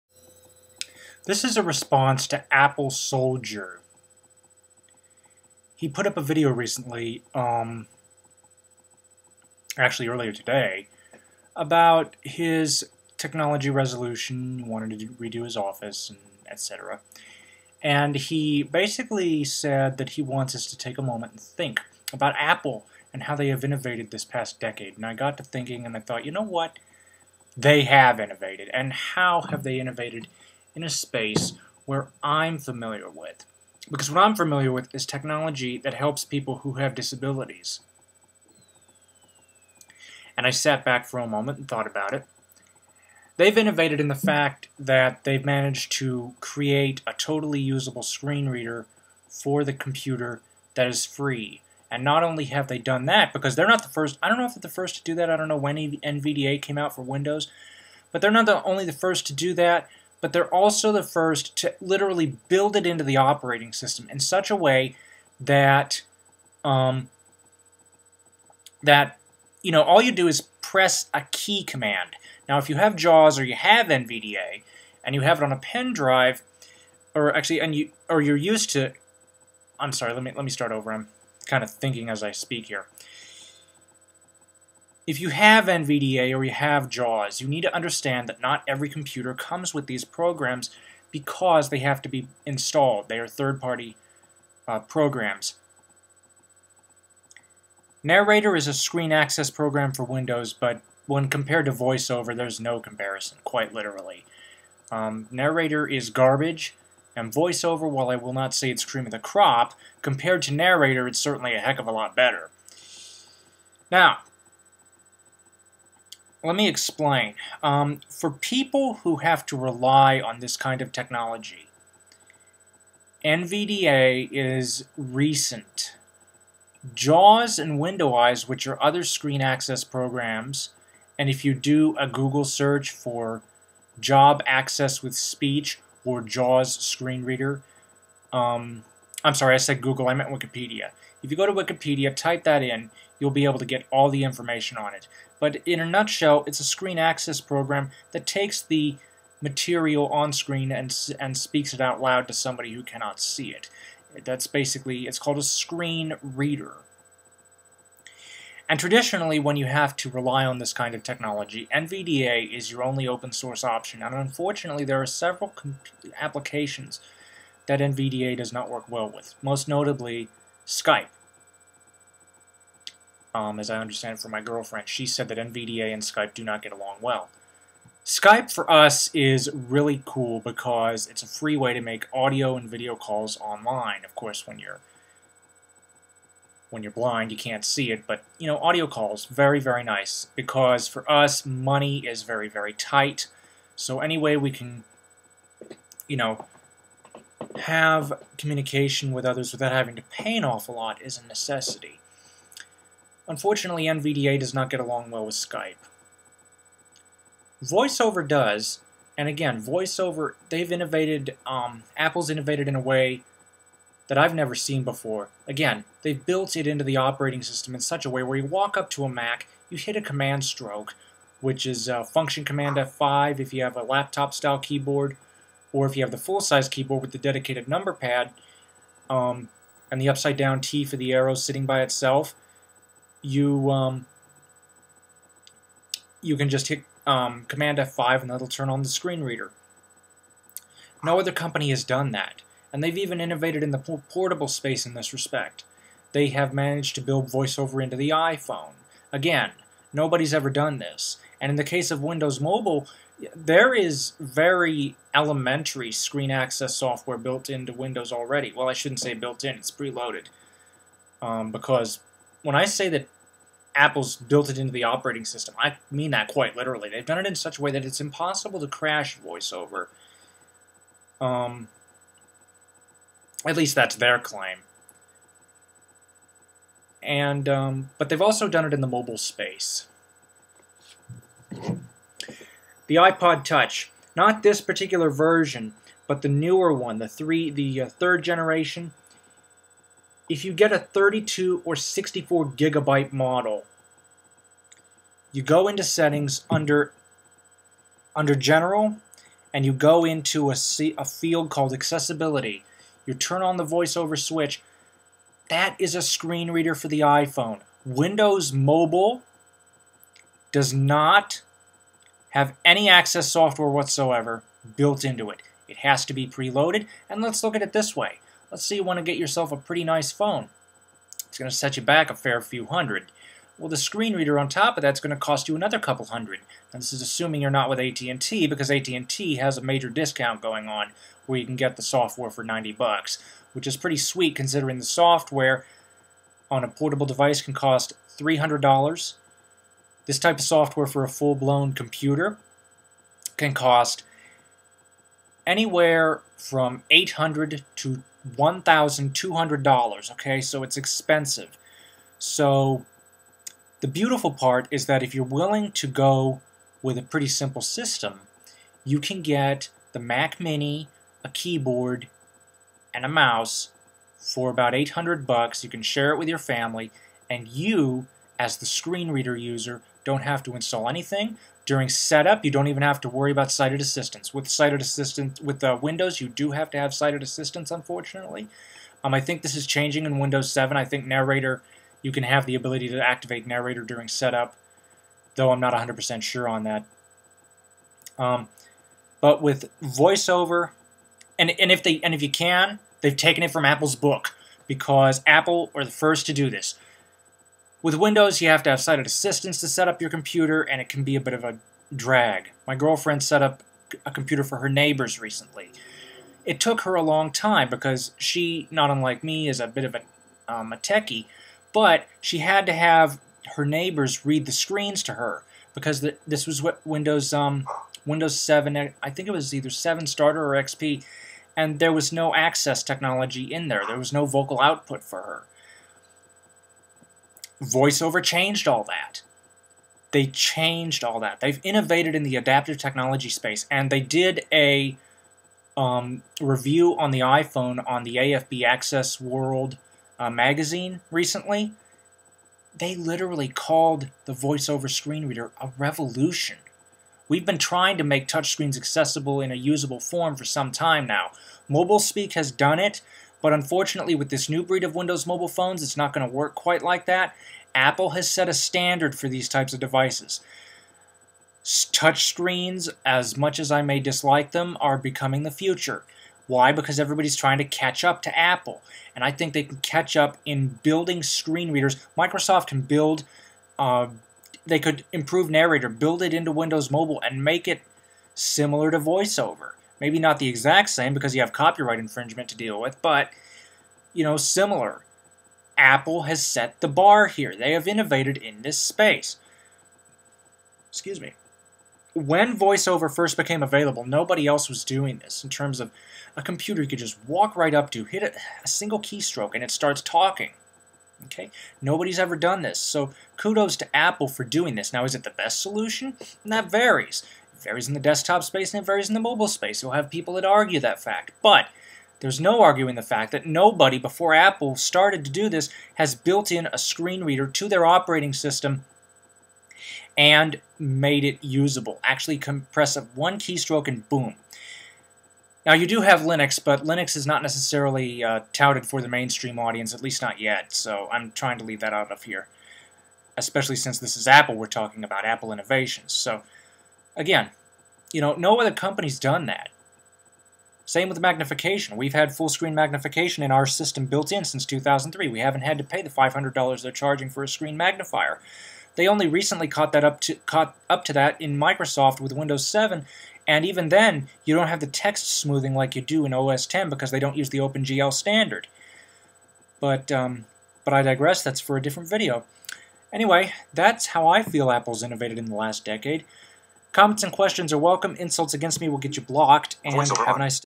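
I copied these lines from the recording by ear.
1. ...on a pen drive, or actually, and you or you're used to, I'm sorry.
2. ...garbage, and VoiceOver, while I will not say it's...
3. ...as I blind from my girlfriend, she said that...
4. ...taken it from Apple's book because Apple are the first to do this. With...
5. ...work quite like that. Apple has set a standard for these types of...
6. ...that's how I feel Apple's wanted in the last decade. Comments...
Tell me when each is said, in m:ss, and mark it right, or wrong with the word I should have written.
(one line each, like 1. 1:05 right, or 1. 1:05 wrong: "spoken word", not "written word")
1. 1:15 right
2. 1:46 right
3. 2:53 wrong: "understand", not "blind"
4. 6:33 right
5. 7:36 right
6. 9:23 wrong: "innovated", not "wanted".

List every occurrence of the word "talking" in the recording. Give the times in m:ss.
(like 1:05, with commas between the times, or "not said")
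8:20, 8:54.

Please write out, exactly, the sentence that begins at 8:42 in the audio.
Actually compress up one keystroke and boom.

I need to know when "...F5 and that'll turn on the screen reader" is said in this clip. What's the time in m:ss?
3:57.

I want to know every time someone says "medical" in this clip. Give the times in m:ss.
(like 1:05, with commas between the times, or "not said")
not said.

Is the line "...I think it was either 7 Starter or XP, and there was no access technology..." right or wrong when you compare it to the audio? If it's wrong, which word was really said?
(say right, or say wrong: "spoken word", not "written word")
right.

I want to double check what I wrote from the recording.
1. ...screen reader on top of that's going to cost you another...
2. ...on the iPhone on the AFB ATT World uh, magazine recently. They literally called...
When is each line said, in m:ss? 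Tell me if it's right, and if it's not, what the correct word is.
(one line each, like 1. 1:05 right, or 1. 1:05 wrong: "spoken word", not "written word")
1. 5:23 right
2. 7:16 wrong: "Access", not "ATT".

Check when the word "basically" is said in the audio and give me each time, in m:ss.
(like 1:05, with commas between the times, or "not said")
0:18, 2:34.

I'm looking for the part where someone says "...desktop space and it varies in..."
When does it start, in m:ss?
8:27.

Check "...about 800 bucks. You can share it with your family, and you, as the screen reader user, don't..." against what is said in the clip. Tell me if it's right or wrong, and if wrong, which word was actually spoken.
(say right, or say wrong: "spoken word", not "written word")
right.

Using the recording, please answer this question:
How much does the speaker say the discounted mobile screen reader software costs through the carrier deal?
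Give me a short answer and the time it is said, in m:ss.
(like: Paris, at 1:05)
$90, at 5:32.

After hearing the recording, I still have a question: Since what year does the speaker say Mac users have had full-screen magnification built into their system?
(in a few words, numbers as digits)
2003.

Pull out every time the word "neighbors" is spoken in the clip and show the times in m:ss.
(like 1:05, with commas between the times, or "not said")
6:44, 6:53.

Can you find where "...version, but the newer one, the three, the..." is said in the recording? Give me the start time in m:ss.
4:45.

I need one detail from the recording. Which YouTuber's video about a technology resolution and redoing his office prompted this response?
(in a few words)
AppleSoldier.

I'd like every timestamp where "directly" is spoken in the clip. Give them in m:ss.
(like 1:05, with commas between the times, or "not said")
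not said.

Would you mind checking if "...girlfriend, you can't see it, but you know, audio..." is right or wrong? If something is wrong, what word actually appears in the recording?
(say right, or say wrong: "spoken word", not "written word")
wrong: "blind", not "girlfriend".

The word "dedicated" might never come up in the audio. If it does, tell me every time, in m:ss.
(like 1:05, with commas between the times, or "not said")
3:47.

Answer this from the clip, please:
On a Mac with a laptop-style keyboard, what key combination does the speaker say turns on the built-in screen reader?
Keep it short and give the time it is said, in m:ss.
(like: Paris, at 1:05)
Function Command F5, at 3:42.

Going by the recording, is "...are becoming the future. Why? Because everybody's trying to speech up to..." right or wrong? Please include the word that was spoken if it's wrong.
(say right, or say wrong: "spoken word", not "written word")
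wrong: "catch", not "speech".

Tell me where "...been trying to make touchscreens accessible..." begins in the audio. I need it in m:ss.
7:27.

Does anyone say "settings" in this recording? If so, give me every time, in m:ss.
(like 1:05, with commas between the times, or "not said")
4:55.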